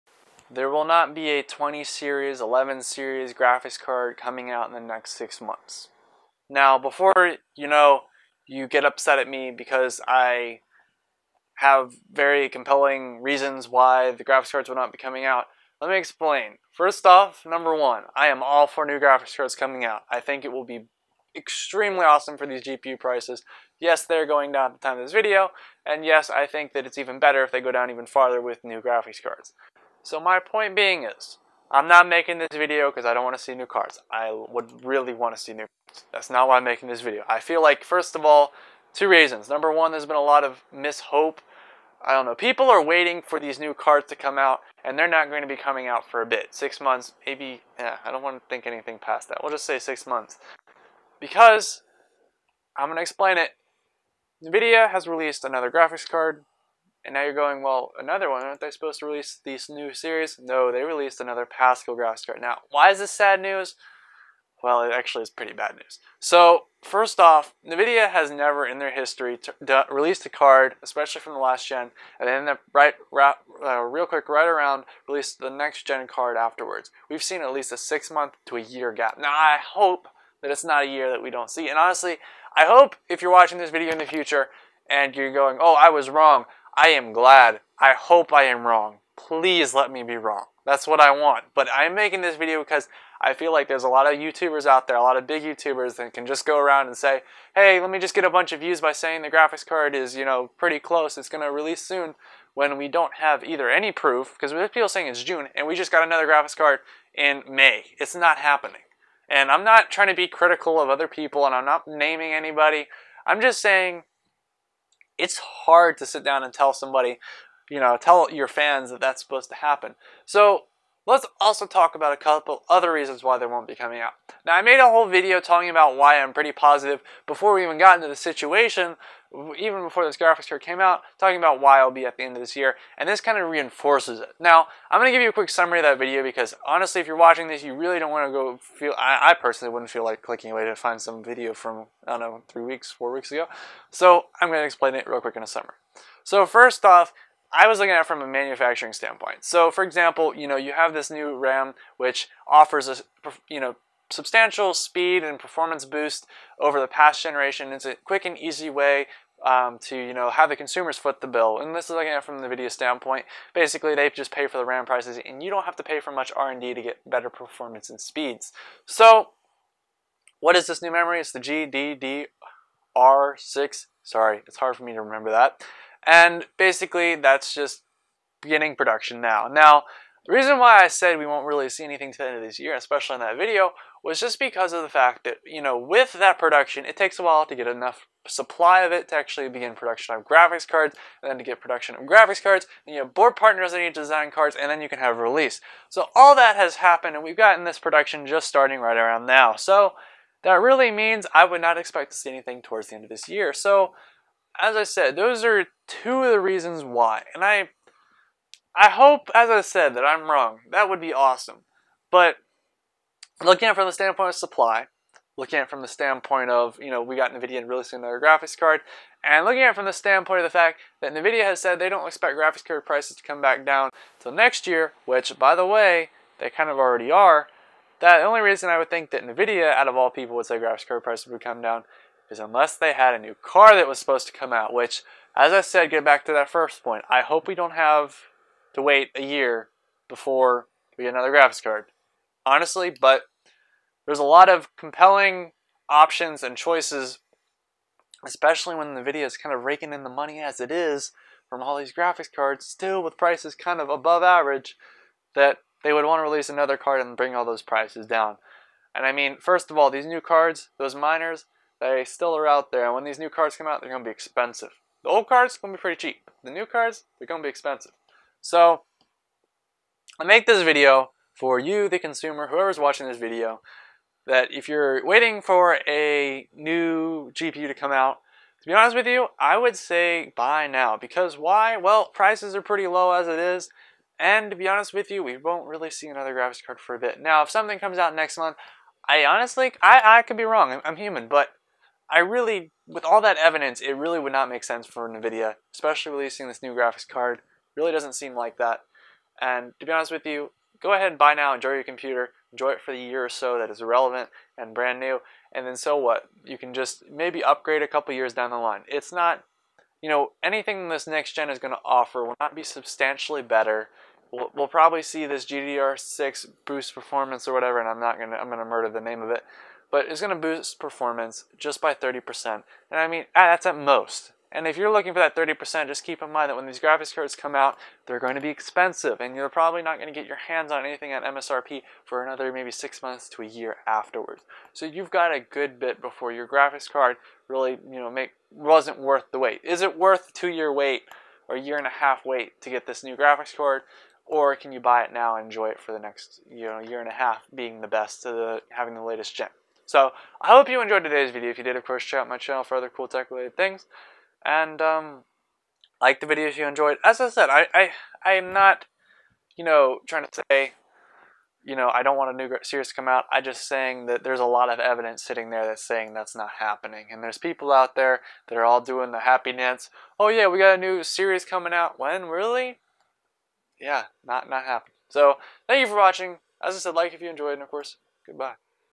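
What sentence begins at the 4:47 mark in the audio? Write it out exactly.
Now, if something comes out next month, I honestly, I, I could be wrong.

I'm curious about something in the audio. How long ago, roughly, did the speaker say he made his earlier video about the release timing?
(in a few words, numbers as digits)
3 to 4 weeks.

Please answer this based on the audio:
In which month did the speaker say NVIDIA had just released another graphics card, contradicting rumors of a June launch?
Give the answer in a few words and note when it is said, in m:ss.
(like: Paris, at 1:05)
May, at 1:47.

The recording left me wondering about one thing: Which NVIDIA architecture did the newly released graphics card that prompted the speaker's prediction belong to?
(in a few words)
Pascal.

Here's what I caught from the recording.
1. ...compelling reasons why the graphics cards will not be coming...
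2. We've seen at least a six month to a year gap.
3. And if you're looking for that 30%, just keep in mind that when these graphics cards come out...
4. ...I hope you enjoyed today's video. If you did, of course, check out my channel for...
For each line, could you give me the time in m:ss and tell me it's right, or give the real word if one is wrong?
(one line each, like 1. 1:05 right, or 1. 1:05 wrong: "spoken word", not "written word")
1. 0:12 right
2. 1:17 right
3. 5:24 right
4. 5:50 right.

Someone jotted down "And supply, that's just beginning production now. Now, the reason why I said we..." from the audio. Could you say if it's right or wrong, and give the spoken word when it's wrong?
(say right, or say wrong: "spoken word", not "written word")
wrong: "basically", not "supply".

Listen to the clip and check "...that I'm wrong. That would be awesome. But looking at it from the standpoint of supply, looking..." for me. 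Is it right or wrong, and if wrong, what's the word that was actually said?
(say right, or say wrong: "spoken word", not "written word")
right.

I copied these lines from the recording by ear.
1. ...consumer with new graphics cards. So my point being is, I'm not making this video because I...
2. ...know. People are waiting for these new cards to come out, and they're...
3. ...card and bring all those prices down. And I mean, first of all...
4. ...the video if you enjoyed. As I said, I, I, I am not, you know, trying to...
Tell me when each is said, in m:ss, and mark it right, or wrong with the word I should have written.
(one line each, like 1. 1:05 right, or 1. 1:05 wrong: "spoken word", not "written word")
1. 0:28 wrong: "farther", not "consumer"
2. 0:42 right
3. 4:16 right
4. 5:56 right.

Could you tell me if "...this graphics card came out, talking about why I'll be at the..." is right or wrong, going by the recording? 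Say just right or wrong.
right.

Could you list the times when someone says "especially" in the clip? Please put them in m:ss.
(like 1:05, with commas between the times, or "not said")
1:10, 3:02, 4:08, 4:55.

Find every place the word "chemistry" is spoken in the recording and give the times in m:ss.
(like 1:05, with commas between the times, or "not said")
not said.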